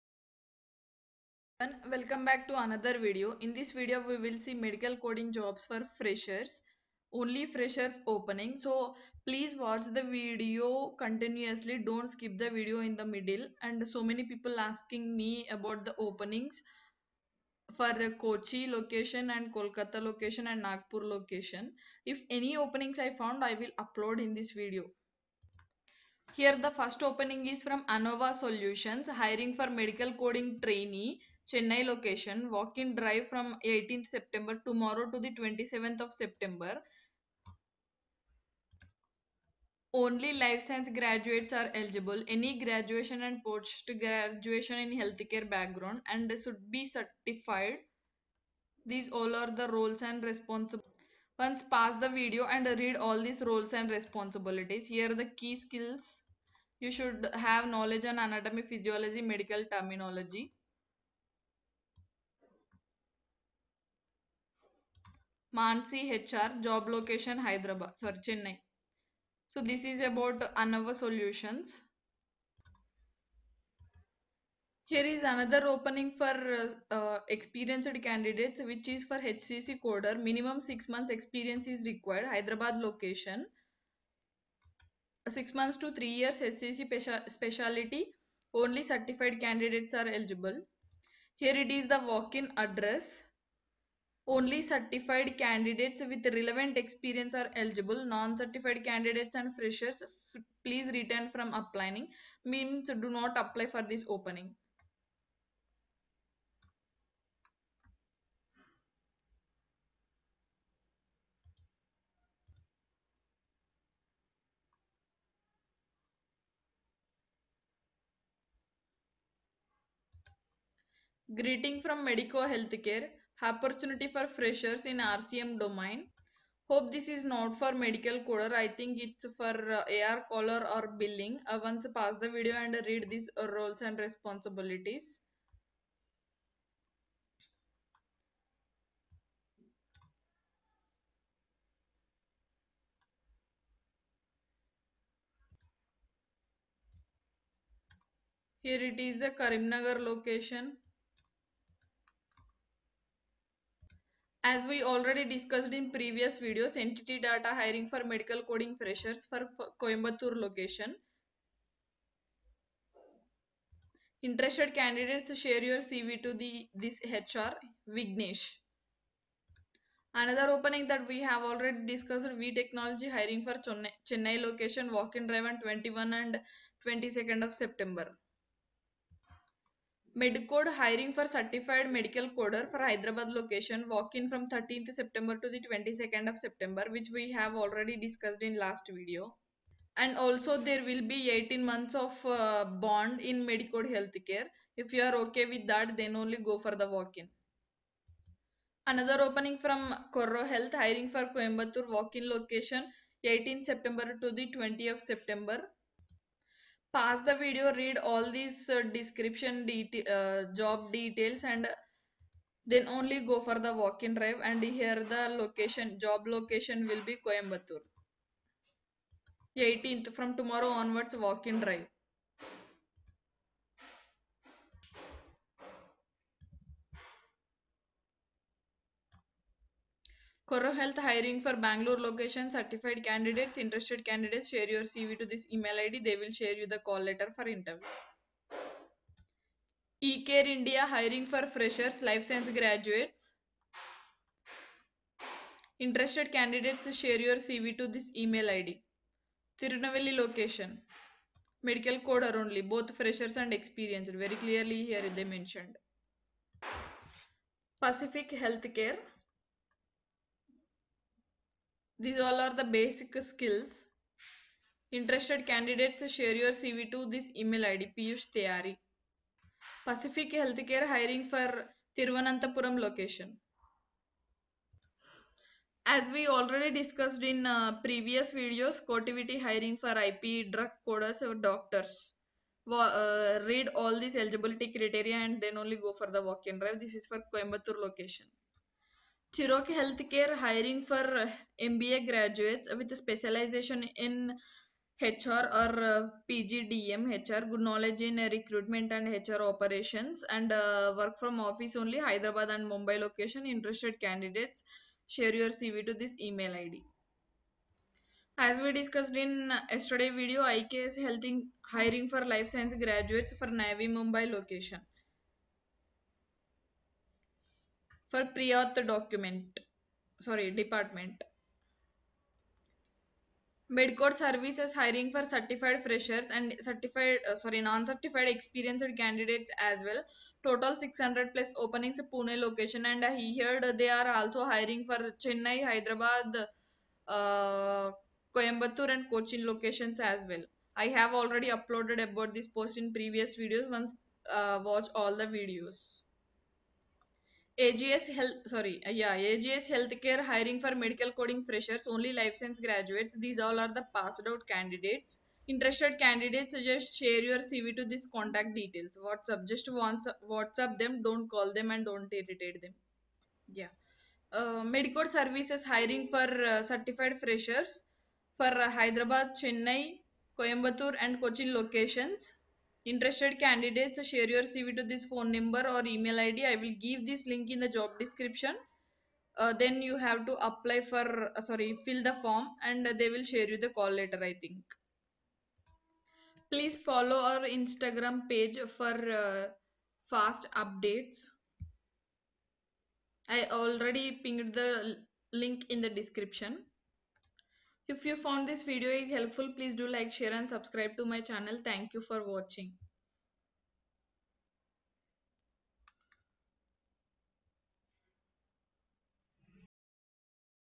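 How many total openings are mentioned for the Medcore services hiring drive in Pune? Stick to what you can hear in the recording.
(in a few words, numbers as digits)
600+.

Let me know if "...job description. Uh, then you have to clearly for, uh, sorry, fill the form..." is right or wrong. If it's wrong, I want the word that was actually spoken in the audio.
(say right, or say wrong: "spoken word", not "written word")
wrong: "apply", not "clearly".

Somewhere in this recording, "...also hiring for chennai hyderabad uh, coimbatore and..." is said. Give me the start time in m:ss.
5:34.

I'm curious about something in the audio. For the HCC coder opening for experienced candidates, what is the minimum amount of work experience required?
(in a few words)
6 months.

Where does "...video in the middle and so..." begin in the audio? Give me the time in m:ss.
0:12.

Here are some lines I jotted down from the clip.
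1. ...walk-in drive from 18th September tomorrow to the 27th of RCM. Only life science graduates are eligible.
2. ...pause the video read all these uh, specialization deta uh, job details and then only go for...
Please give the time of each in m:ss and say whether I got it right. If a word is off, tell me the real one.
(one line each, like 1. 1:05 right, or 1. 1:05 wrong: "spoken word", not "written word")
1. 0:32 wrong: "September", not "RCM"
2. 3:26 wrong: "description", not "specialization".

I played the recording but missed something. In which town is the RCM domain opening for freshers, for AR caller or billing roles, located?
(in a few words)
Karimnagar.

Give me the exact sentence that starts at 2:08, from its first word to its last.
I think it's for uh, AR caller or billing.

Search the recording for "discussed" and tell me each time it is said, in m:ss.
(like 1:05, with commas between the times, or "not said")
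2:35, 2:51, 3:07, 4:36, 5:08.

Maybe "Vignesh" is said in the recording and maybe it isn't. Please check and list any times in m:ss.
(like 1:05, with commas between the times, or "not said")
2:47.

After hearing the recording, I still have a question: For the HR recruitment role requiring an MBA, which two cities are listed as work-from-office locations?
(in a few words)
Hyderabad and Mumbai.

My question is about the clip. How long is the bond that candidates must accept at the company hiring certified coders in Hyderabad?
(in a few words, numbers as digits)
18 months.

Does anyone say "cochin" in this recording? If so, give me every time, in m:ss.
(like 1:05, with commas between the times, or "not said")
5:39, 6:11.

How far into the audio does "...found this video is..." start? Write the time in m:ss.
6:38.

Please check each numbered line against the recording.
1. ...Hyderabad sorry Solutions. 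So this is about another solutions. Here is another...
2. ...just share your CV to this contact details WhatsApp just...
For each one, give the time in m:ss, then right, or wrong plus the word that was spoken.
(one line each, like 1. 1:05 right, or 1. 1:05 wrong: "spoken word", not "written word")
1. 1:07 wrong: "Chennai", not "Solutions"
2. 5:56 right.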